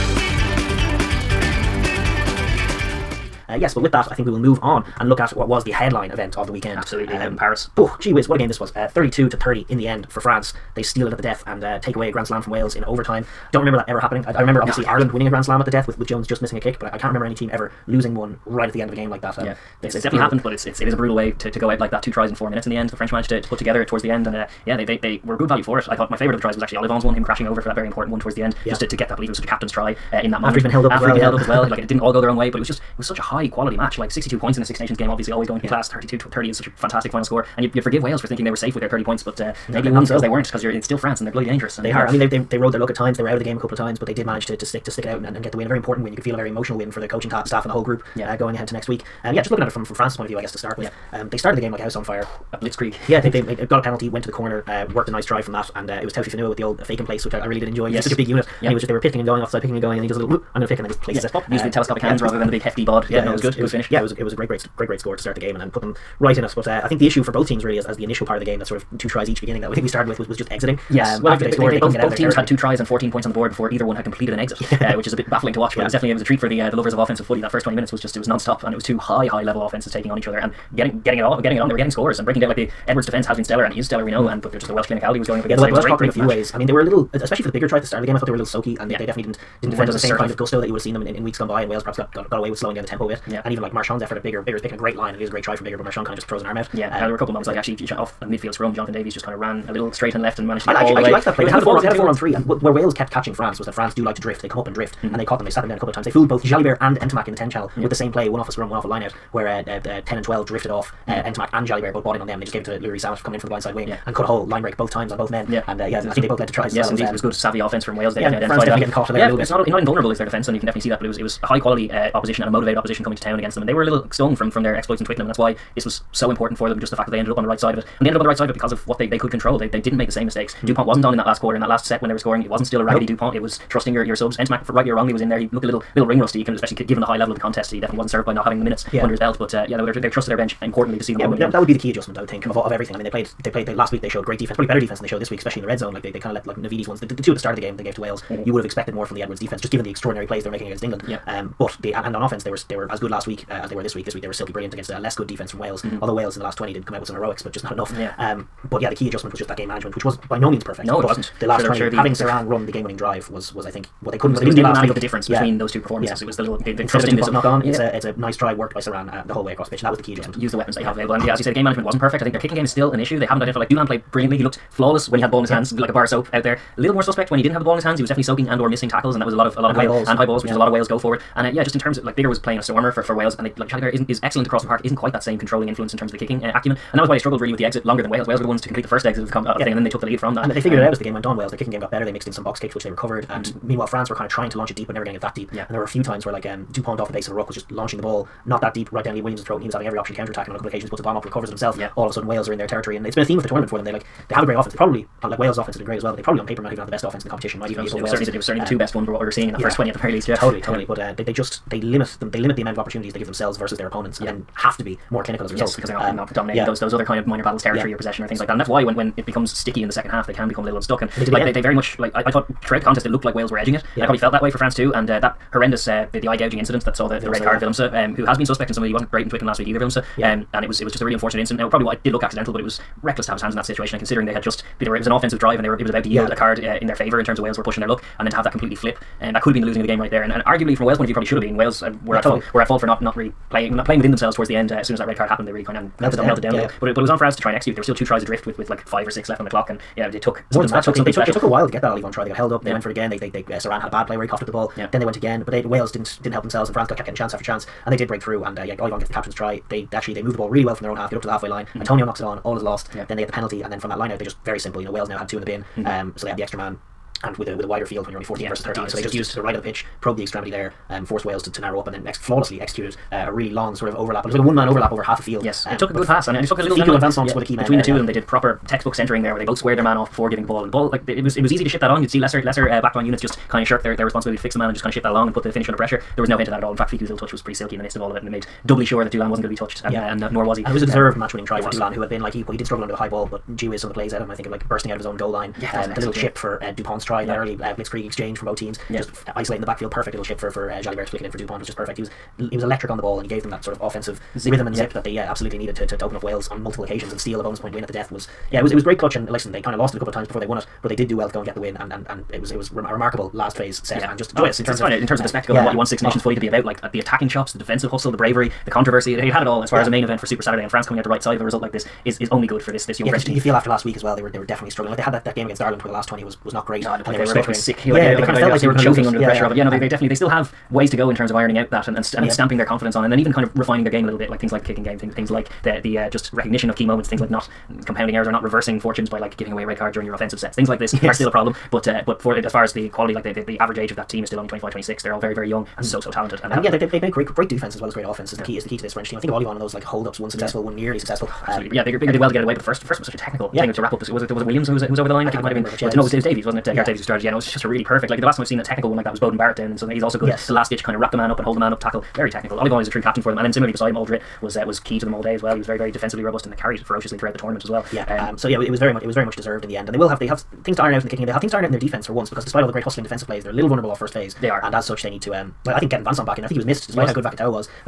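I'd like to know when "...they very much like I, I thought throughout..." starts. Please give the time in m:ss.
3:41.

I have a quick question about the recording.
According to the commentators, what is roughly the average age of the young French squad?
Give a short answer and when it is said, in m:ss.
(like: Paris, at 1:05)
25 or 26, at 5:44.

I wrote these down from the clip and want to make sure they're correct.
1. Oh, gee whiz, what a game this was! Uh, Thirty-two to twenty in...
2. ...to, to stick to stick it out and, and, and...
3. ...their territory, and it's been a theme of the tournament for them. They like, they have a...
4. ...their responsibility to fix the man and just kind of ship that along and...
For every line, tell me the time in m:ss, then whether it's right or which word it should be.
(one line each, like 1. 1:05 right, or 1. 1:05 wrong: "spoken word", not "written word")
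1. 0:07 wrong: "thirty", not "twenty"
2. 0:44 right
3. 3:22 right
4. 4:43 right.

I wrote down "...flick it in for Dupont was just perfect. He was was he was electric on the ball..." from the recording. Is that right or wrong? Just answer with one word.
right.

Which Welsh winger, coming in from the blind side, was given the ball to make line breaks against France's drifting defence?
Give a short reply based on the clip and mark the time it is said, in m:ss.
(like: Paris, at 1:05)
Louis Samet, at 1:52.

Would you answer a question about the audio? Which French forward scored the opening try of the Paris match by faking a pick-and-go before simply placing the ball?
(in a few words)
Taofifenua.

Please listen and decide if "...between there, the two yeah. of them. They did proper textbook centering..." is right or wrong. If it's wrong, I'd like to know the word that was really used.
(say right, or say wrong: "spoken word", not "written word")
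right.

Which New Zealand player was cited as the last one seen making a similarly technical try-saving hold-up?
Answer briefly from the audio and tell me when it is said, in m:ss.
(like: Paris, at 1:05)
Beauden Barrett, at 5:59.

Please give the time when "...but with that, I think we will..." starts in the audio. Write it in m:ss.
0:03.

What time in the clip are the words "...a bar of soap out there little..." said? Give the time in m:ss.
2:55.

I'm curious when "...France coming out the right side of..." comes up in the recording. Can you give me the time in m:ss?
5:20.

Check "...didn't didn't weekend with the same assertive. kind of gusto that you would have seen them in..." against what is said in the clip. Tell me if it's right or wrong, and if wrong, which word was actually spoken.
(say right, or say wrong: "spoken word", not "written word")
wrong: "defend", not "weekend".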